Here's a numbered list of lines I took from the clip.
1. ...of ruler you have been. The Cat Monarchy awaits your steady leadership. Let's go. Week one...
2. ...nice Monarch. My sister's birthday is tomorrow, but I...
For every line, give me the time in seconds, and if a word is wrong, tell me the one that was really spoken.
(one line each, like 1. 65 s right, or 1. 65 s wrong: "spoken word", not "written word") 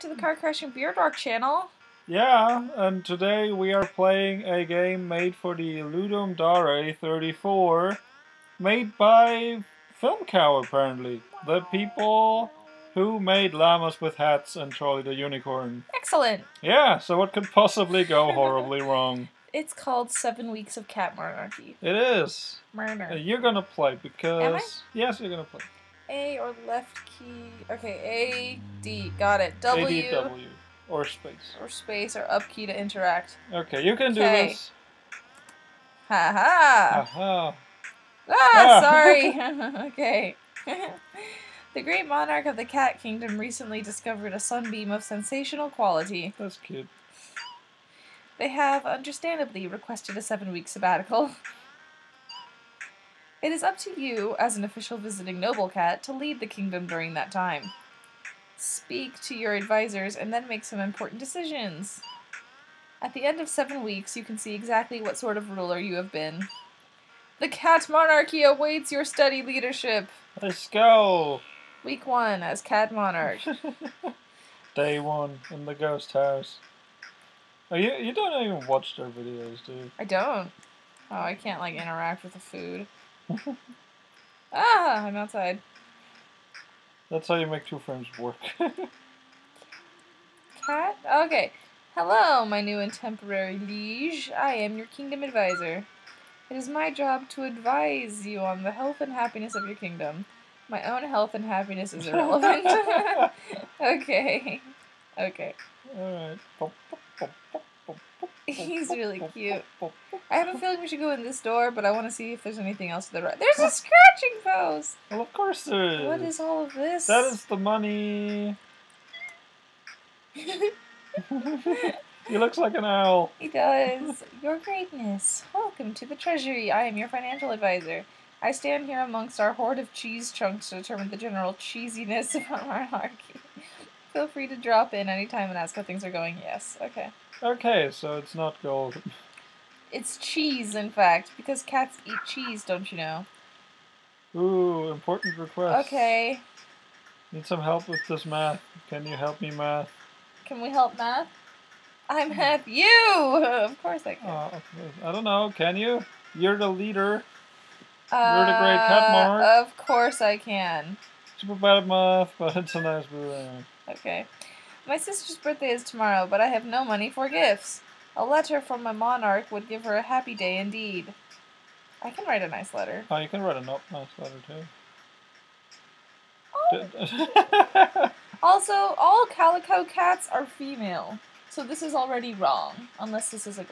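1. 65 s right
2. 162 s wrong: "Okay", not "Monarch".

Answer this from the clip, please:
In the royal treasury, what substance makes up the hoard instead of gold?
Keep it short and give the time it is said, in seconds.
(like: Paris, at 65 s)
Cheese chunks, at 129 s.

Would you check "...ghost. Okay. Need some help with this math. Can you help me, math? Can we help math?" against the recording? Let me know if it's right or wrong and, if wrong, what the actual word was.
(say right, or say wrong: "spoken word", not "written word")
wrong: "request", not "ghost".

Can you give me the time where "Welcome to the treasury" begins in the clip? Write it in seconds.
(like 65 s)
125 s.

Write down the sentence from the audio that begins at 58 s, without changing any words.
Speak to your advisors and then make some important decisions.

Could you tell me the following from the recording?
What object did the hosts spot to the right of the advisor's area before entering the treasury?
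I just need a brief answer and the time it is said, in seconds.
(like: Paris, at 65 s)
A scratching post, at 113 s.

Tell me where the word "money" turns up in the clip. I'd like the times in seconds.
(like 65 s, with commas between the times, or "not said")
117 s, 166 s.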